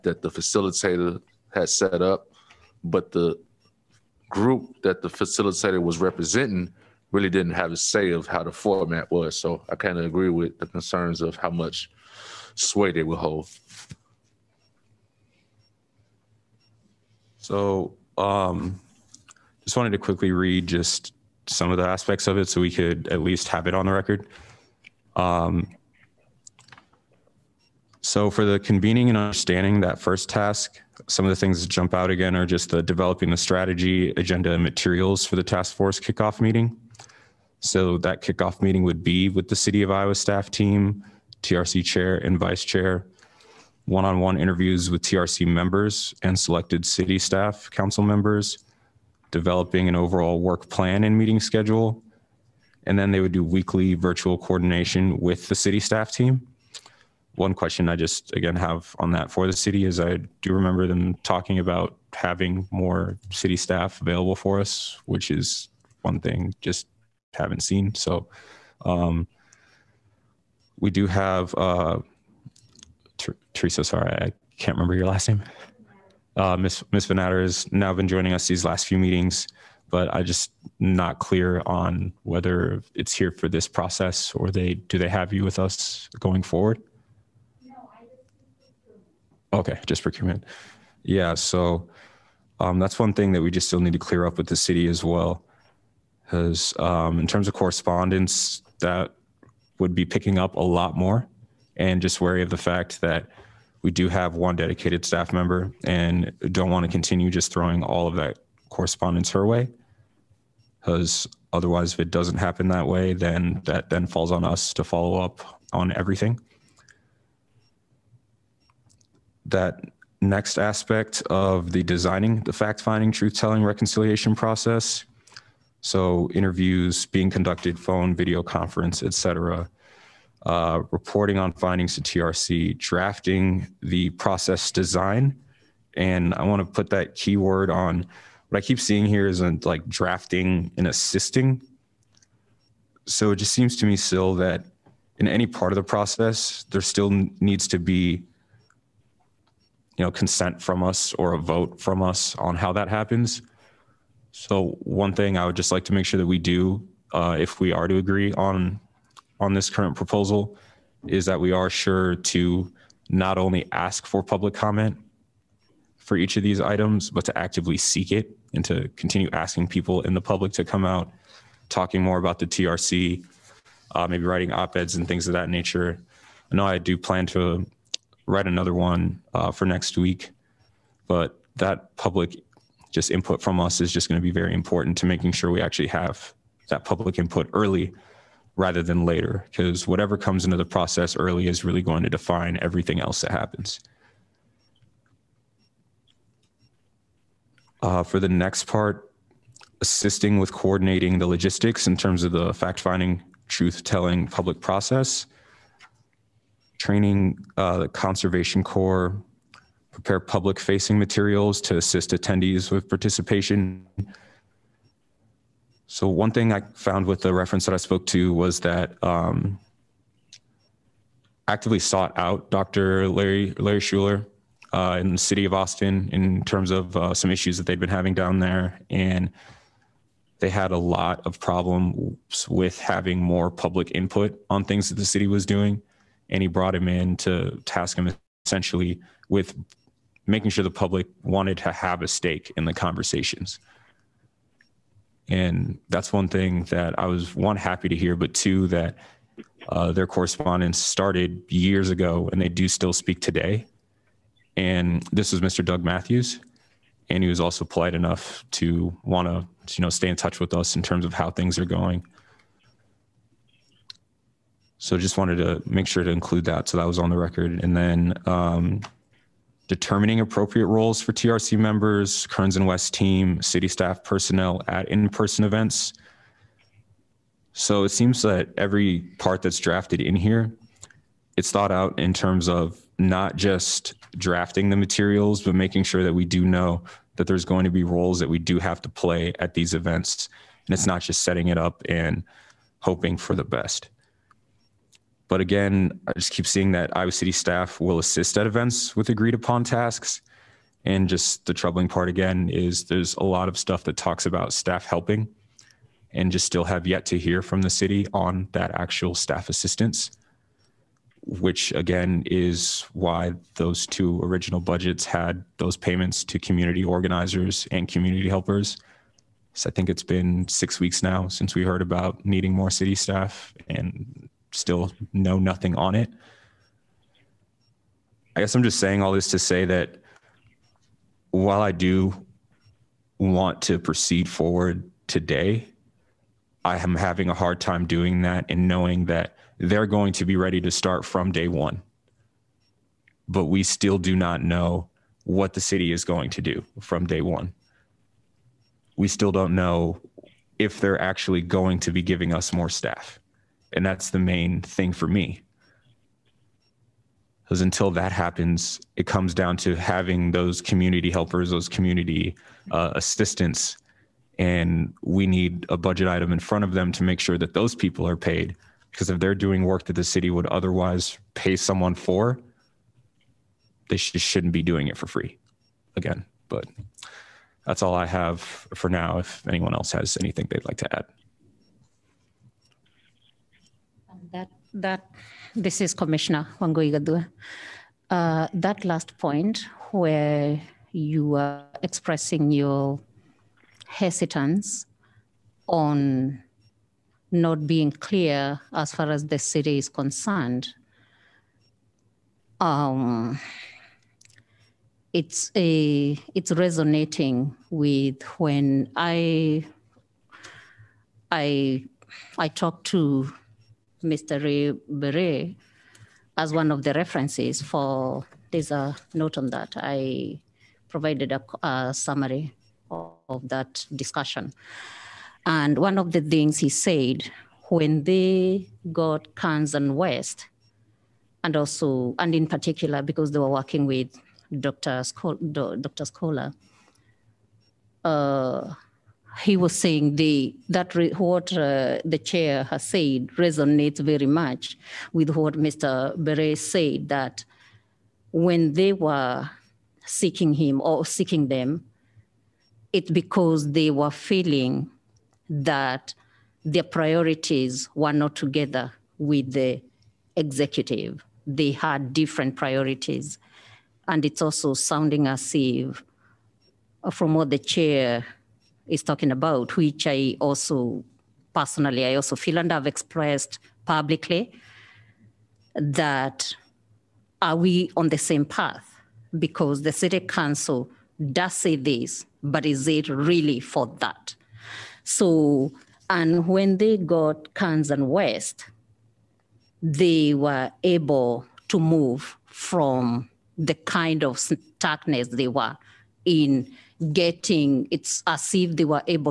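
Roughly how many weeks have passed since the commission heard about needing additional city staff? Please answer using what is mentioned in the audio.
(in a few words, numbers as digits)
6.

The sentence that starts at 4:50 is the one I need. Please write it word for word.
And it's not just setting it up and hoping for the best.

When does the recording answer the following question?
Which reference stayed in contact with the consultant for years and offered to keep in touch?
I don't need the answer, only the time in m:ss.
4:15.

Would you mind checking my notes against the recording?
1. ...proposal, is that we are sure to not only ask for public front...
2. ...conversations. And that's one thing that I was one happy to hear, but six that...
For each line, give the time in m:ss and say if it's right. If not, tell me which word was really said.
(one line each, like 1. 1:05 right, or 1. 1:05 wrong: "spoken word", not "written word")
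1. 2:39 wrong: "comment", not "front"
2. 4:02 wrong: "two", not "six".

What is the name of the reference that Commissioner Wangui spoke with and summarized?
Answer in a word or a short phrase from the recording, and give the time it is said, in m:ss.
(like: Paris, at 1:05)
Ray Beret, at 6:54.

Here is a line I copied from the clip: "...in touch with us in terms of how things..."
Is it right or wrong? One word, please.
right.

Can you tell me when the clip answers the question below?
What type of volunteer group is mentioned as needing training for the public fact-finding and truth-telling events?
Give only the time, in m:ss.
3:27.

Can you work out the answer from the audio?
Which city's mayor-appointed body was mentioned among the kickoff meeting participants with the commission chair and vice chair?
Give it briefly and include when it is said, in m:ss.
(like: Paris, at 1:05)
Iowa City, at 0:39.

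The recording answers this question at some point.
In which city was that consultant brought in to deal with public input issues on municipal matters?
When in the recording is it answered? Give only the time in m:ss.
3:45.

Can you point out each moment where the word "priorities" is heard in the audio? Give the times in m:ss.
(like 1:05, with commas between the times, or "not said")
7:36, 7:42.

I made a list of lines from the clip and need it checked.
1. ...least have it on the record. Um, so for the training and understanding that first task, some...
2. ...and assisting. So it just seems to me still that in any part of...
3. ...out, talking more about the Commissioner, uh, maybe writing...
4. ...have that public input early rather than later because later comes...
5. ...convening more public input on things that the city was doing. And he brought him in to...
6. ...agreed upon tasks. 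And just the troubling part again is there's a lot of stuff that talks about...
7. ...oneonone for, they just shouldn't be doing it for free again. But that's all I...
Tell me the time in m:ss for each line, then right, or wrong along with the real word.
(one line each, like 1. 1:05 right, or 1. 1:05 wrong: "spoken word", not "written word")
1. 0:23 wrong: "convening", not "training"
2. 2:20 right
3. 2:50 wrong: "TRC", not "Commissioner"
4. 3:05 wrong: "whatever", not "later"
5. 3:52 wrong: "having", not "convening"
6. 4:59 right
7. 6:11 wrong: "someone", not "oneonone".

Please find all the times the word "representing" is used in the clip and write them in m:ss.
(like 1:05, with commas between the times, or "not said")
0:05.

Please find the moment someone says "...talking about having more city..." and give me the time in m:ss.
1:01.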